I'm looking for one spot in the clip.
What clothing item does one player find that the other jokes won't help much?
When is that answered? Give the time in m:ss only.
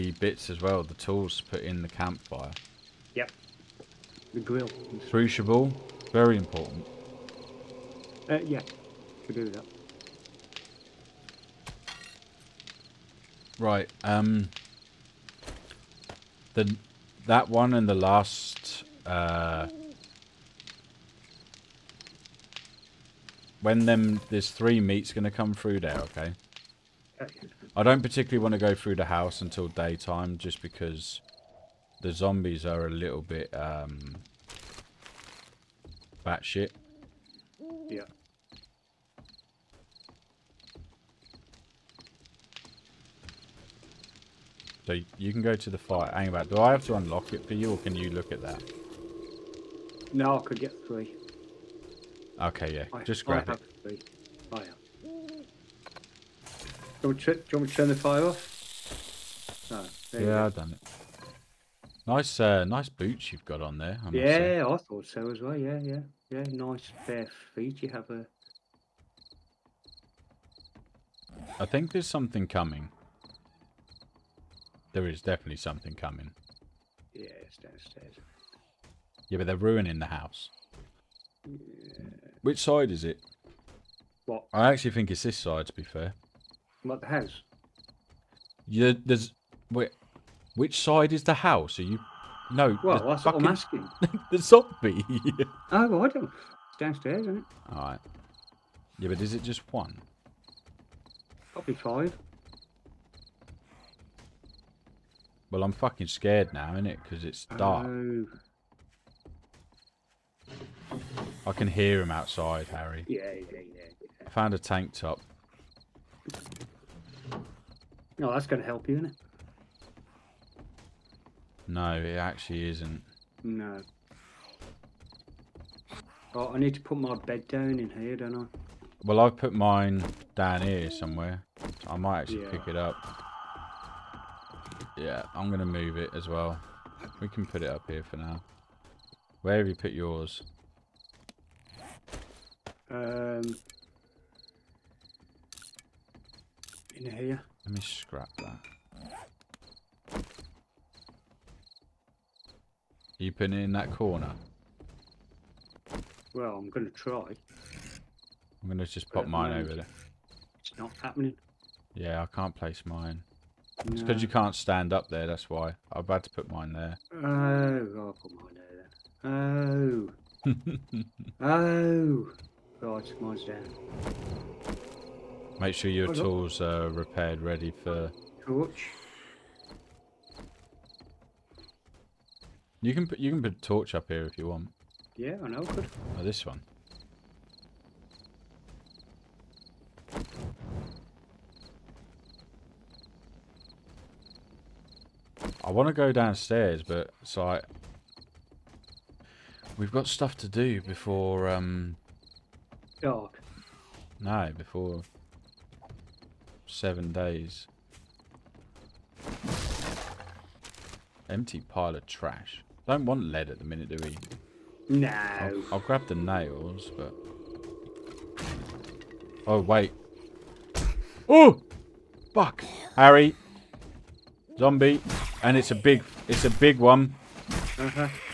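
1:54.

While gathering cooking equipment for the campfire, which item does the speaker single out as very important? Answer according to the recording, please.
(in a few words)
Crucible.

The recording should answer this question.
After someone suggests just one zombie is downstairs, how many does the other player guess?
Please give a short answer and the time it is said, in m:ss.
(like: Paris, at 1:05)
5, at 1:41.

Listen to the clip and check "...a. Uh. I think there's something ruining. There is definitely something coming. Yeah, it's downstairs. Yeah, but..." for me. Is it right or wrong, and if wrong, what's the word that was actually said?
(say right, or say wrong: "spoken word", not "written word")
wrong: "coming", not "ruining".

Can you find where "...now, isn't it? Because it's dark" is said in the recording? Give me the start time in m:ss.
1:46.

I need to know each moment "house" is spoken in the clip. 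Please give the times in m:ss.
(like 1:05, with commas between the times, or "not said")
0:29, 1:20, 1:27, 1:31.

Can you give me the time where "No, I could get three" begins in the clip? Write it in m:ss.
0:50.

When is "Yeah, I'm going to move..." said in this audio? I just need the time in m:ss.
2:14.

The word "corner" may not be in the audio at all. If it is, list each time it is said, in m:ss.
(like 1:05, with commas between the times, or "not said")
2:33.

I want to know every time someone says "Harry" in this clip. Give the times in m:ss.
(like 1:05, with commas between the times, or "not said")
1:52, 3:42.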